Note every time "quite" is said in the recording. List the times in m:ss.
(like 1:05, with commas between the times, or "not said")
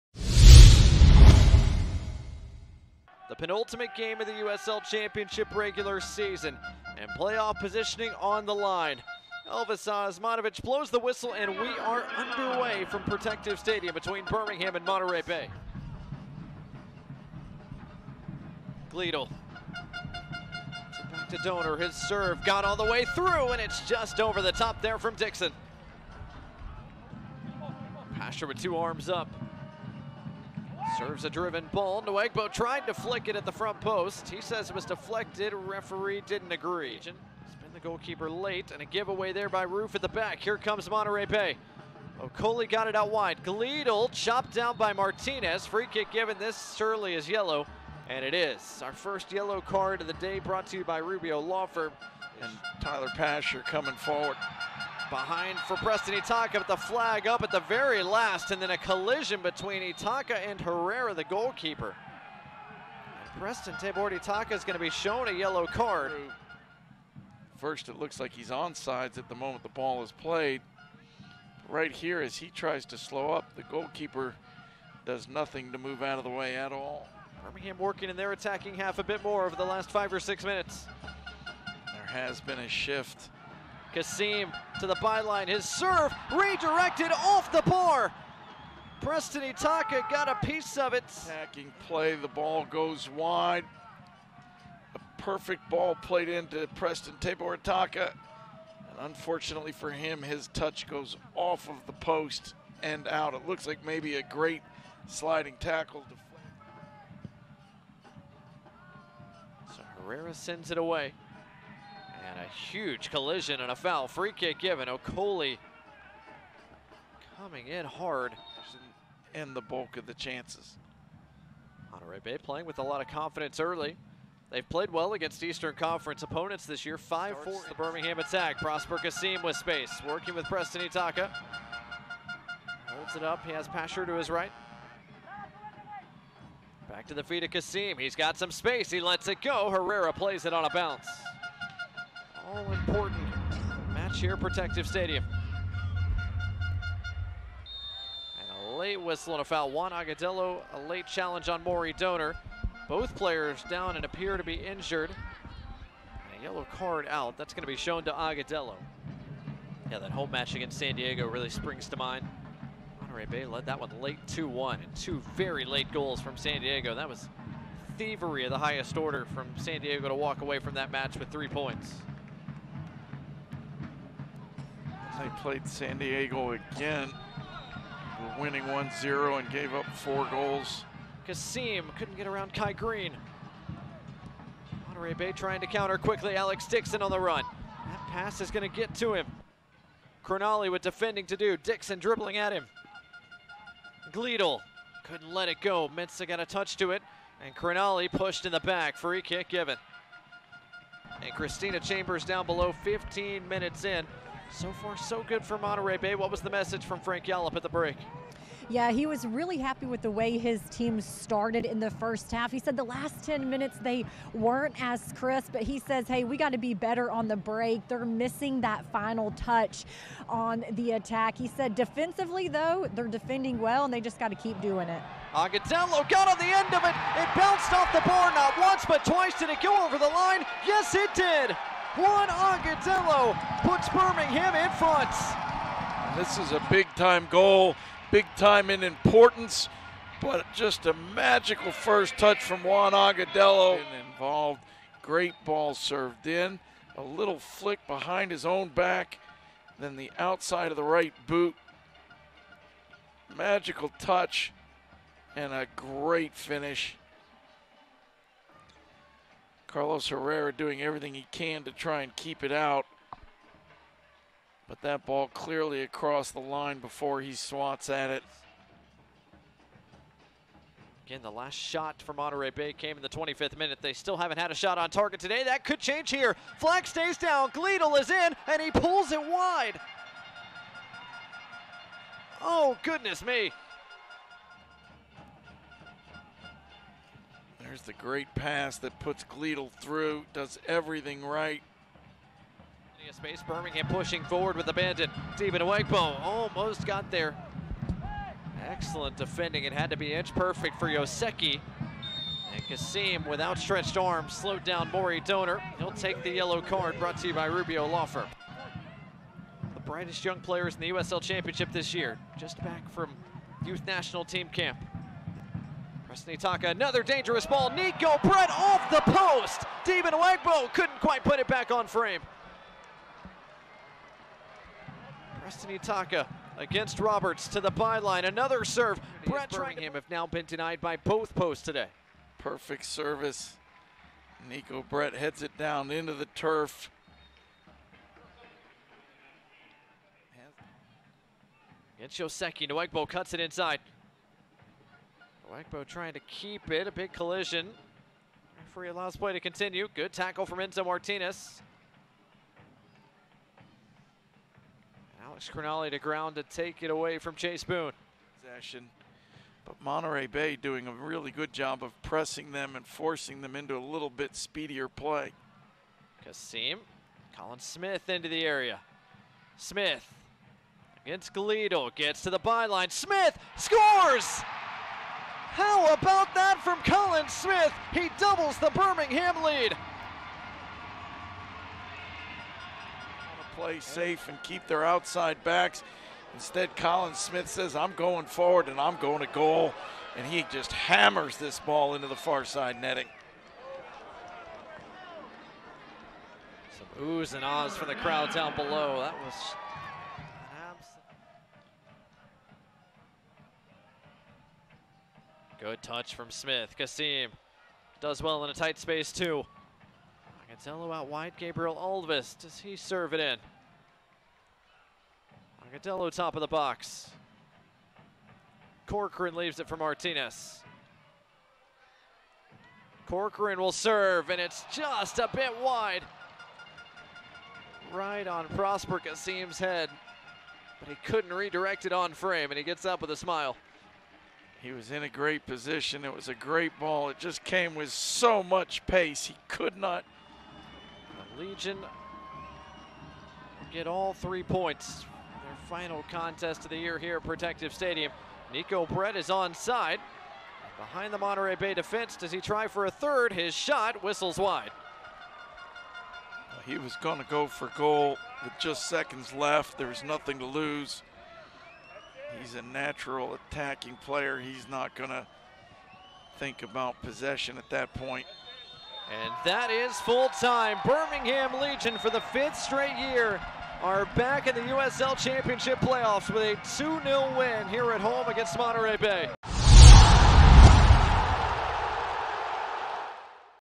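5:20.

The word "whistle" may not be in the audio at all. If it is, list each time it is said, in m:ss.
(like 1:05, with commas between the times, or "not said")
0:10, 2:29, 7:34.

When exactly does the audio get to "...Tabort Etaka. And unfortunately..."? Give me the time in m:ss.
1:37.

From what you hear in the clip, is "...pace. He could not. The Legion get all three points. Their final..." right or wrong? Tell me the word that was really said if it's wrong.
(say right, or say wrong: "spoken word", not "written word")
right.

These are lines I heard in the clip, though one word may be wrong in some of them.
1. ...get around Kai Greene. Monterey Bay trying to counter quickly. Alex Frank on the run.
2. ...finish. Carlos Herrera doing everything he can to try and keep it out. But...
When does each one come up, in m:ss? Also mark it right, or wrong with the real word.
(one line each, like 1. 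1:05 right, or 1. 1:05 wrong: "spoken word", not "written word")
1. 3:02 wrong: "Dixon", not "Frank"
2. 4:16 right.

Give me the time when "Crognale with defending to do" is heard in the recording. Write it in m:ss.
3:10.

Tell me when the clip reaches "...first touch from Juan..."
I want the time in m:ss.
4:01.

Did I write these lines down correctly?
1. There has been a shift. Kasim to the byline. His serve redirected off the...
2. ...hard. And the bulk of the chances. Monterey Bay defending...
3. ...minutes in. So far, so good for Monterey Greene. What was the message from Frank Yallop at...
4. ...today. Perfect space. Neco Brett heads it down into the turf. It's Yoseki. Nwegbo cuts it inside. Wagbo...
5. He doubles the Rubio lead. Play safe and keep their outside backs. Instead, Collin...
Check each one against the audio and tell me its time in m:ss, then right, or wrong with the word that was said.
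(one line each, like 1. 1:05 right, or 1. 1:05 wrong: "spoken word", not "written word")
1. 1:21 right
2. 1:57 wrong: "playing", not "defending"
3. 3:23 wrong: "Bay", not "Greene"
4. 5:31 wrong: "service", not "space"
5. 6:17 wrong: "Birmingham", not "Rubio".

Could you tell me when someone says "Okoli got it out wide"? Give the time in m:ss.
0:42.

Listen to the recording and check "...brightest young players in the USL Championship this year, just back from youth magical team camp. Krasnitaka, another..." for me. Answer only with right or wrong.
wrong.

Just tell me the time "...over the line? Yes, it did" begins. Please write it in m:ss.
3:49.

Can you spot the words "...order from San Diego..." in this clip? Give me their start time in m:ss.
2:48.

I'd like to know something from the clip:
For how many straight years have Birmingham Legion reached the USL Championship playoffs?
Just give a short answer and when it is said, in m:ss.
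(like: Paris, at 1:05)
5, at 7:52.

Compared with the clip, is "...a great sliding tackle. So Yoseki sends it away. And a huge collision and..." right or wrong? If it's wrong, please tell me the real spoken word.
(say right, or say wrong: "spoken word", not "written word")
wrong: "Herrera", not "Yoseki".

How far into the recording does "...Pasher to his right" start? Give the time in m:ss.
2:13.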